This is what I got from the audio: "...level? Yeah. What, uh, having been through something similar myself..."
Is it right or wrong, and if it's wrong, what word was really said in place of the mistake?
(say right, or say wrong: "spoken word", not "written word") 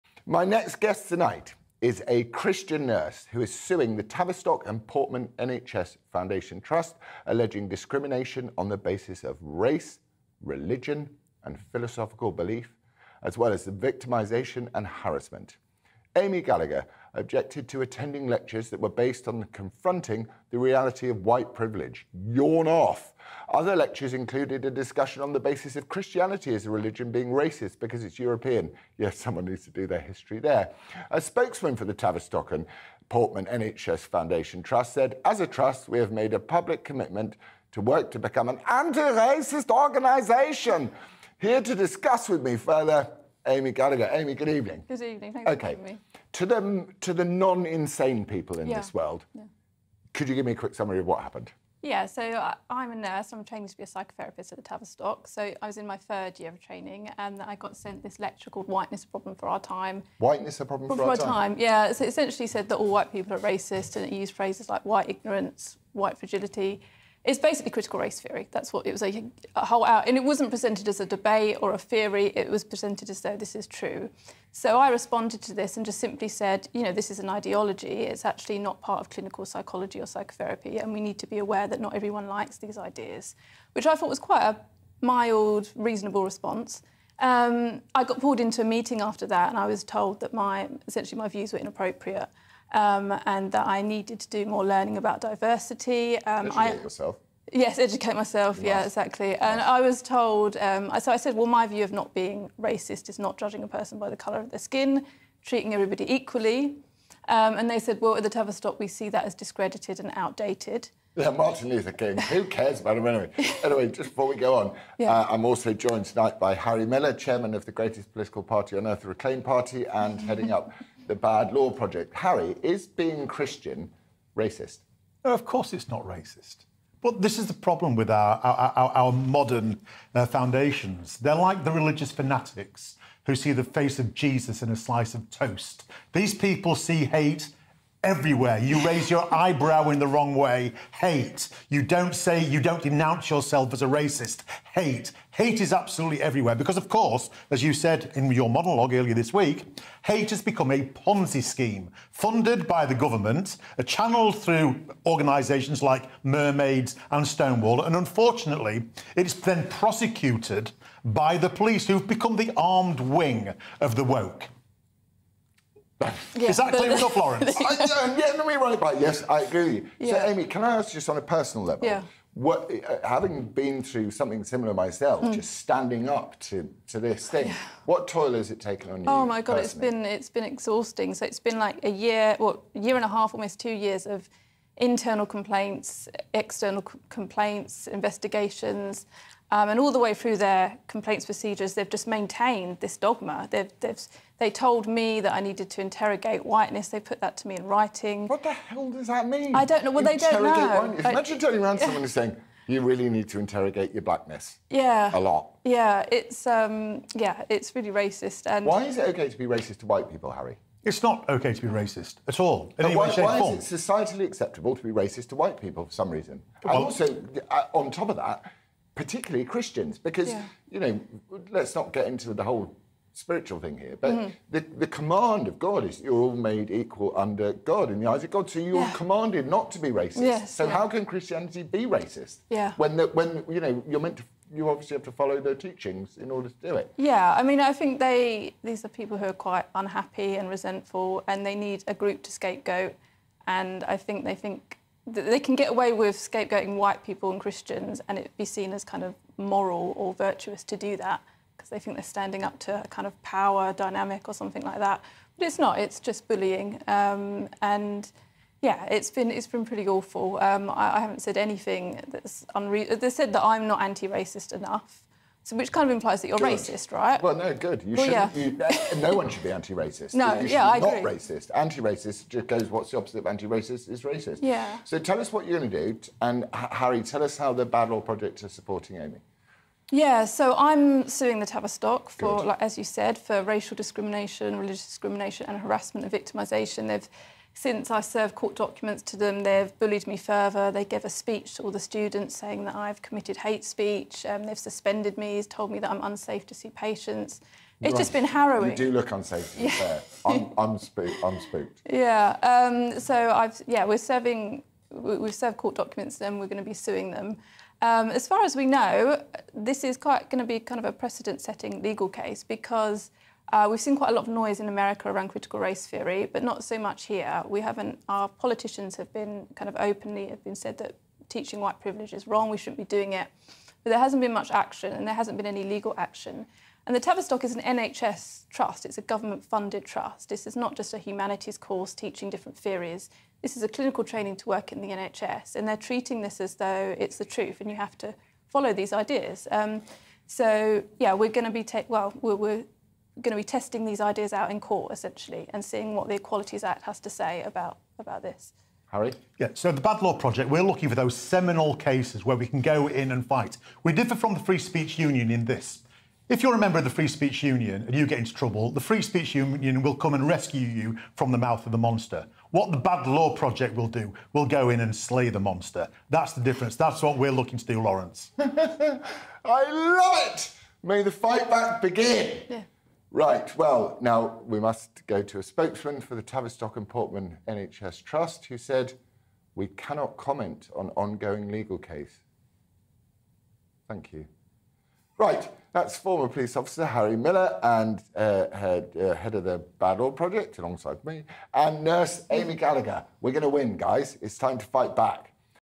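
right.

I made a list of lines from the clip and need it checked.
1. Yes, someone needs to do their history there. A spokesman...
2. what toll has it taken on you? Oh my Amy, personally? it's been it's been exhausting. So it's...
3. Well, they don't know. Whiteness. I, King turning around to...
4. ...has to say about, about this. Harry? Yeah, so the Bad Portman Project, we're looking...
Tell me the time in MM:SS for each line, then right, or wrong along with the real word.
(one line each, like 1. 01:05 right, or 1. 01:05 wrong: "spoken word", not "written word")
1. 00:28 right
2. 02:57 wrong: "God", not "Amy"
3. 03:19 wrong: "Imagine", not "King"
4. 05:46 wrong: "Law", not "Portman".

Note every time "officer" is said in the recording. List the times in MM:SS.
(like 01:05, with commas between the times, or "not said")
06:26.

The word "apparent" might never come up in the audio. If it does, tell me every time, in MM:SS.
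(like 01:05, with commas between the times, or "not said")
not said.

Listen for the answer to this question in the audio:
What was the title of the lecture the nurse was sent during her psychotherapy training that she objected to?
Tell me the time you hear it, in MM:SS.
00:58.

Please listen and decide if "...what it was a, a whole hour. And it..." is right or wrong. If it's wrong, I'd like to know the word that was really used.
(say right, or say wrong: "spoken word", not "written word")
right.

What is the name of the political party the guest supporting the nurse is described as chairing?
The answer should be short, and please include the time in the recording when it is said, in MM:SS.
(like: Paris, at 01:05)
Reclaim Party, at 01:59.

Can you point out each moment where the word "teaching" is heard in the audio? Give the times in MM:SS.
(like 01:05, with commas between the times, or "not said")
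03:55, 05:21, 05:31.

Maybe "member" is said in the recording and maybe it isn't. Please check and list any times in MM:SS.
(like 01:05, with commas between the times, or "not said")
05:56.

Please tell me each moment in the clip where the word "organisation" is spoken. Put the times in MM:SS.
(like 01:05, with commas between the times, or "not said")
00:39, 02:35.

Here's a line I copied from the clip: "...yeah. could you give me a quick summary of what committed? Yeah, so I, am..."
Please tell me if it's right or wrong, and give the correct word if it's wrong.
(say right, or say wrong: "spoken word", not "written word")
wrong: "happened", not "committed".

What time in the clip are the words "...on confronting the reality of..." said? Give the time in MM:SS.
00:19.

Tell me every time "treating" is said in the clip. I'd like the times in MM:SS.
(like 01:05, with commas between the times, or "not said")
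01:45, 05:35.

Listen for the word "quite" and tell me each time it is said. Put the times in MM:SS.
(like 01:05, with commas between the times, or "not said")
01:24, 03:59, 05:09, 05:13.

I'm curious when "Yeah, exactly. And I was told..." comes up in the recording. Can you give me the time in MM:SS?
01:38.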